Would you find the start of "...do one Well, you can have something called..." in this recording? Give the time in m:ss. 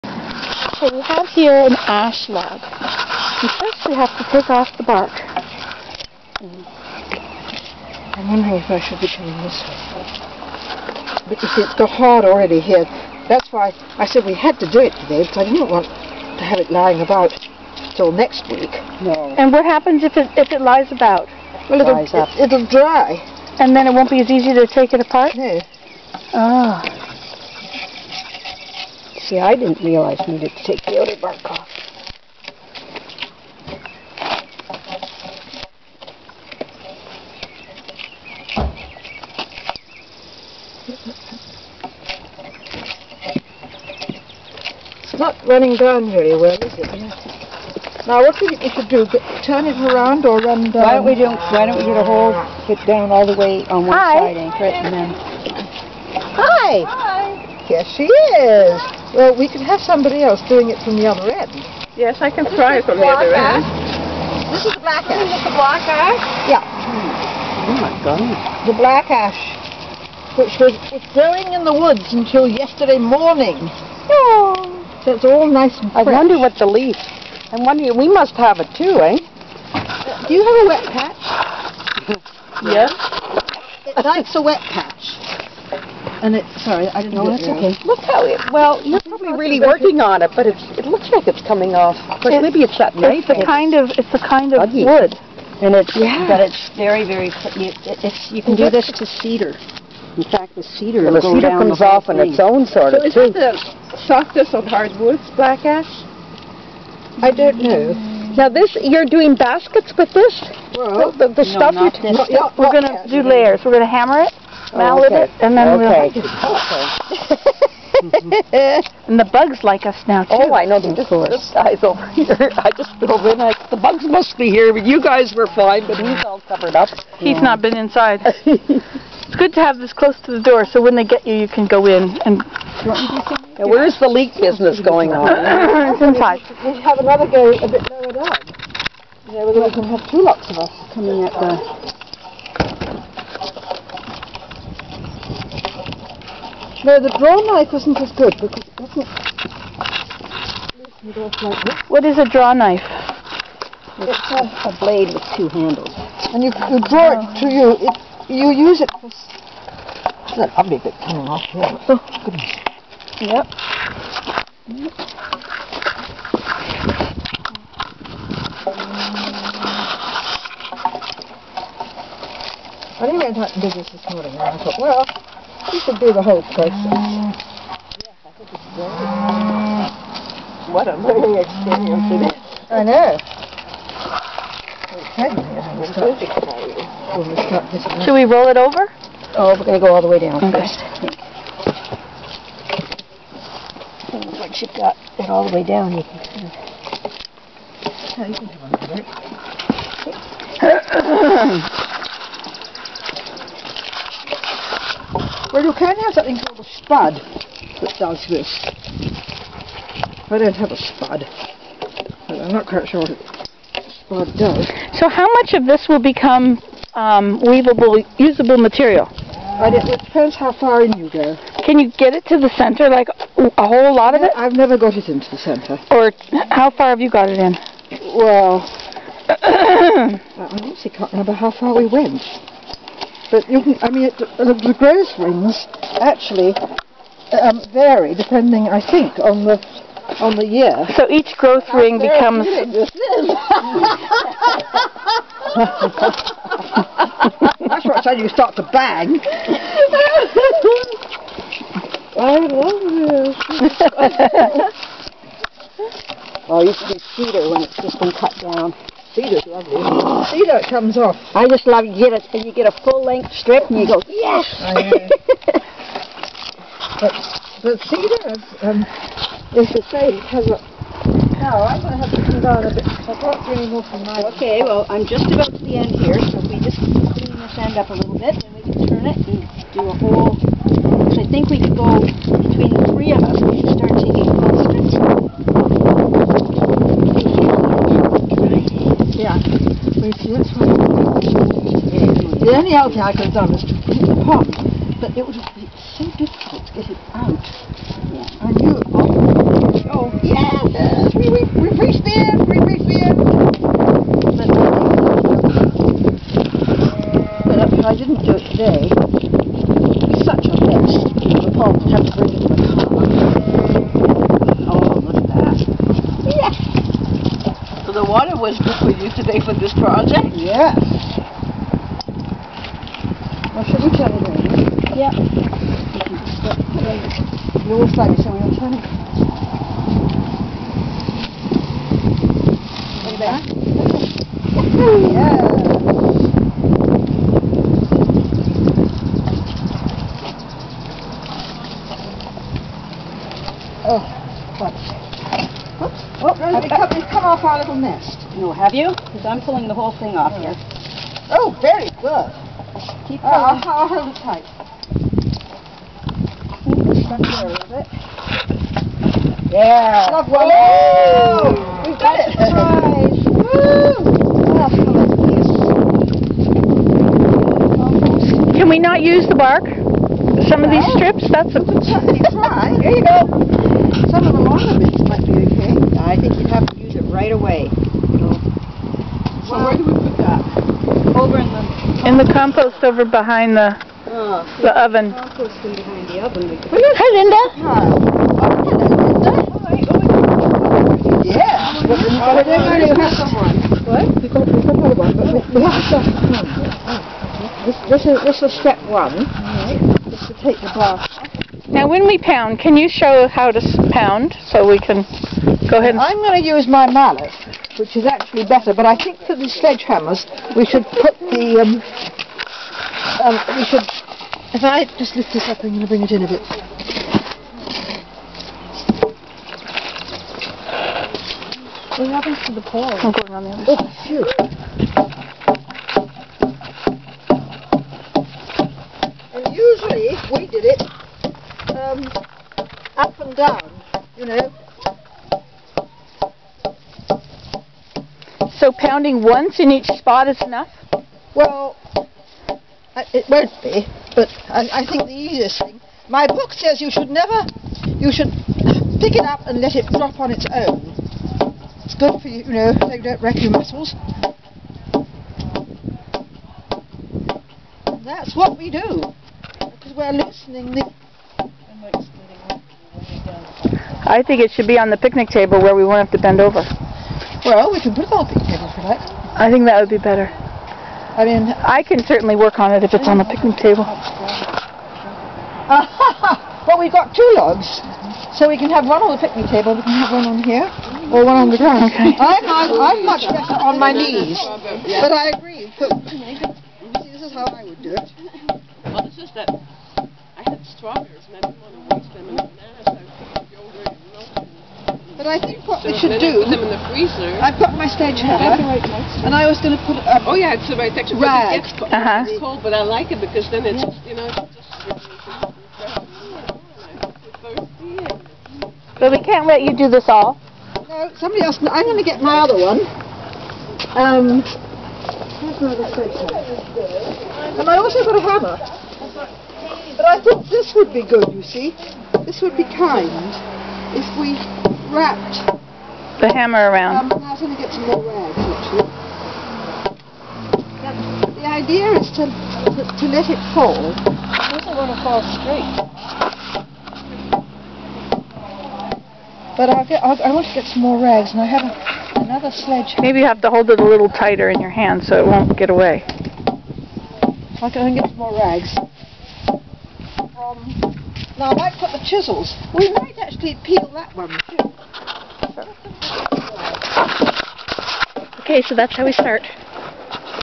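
3:21.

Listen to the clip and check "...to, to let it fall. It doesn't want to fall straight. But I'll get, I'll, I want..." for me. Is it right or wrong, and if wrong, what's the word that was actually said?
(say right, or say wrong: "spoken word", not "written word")
right.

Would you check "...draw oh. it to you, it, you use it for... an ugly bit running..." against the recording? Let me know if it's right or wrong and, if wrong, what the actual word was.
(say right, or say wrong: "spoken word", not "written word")
wrong: "coming", not "running".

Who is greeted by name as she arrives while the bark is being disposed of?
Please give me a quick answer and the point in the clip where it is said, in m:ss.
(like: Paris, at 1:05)
Linda, at 6:27.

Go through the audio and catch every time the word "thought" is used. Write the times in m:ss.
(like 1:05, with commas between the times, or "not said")
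2:54, 8:40.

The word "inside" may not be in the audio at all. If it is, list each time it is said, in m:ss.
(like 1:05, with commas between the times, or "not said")
2:07, 2:16.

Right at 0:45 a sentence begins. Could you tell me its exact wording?
It's not running down very well, is it?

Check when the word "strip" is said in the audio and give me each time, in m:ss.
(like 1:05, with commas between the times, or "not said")
4:23, 6:10.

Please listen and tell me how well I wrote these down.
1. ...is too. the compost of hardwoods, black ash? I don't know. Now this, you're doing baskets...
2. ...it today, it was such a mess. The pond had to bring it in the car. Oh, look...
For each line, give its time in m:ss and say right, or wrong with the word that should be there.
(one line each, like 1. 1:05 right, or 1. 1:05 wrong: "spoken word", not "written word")
1. 1:43 wrong: "softest", not "compost"
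2. 5:08 right.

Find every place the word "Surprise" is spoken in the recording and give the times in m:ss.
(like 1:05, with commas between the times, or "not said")
6:02.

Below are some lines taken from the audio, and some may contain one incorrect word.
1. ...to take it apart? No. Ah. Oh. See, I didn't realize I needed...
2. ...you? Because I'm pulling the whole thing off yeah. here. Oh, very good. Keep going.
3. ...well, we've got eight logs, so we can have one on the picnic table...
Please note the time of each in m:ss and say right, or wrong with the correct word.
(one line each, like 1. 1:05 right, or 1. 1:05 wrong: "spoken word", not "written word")
1. 0:24 right
2. 5:48 right
3. 7:56 wrong: "two", not "eight".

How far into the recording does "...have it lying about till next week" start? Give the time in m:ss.
0:16.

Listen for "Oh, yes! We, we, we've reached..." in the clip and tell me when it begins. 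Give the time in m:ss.
4:59.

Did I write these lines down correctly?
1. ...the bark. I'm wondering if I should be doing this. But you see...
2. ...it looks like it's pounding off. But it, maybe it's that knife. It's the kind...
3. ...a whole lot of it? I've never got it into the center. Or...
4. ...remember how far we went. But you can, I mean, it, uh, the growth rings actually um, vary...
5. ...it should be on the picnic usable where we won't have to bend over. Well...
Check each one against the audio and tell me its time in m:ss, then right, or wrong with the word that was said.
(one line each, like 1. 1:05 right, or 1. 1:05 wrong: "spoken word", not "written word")
1. 0:04 right
2. 1:30 wrong: "coming", not "pounding"
3. 3:43 right
4. 3:51 right
5. 7:44 wrong: "table", not "usable".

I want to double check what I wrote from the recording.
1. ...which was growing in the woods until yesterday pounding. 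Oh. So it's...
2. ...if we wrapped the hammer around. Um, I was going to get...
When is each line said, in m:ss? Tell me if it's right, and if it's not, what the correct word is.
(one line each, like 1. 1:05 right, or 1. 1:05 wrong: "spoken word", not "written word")
1. 1:10 wrong: "morning", not "pounding"
2. 8:44 right.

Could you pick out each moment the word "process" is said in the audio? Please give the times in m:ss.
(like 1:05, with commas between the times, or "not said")
2:56.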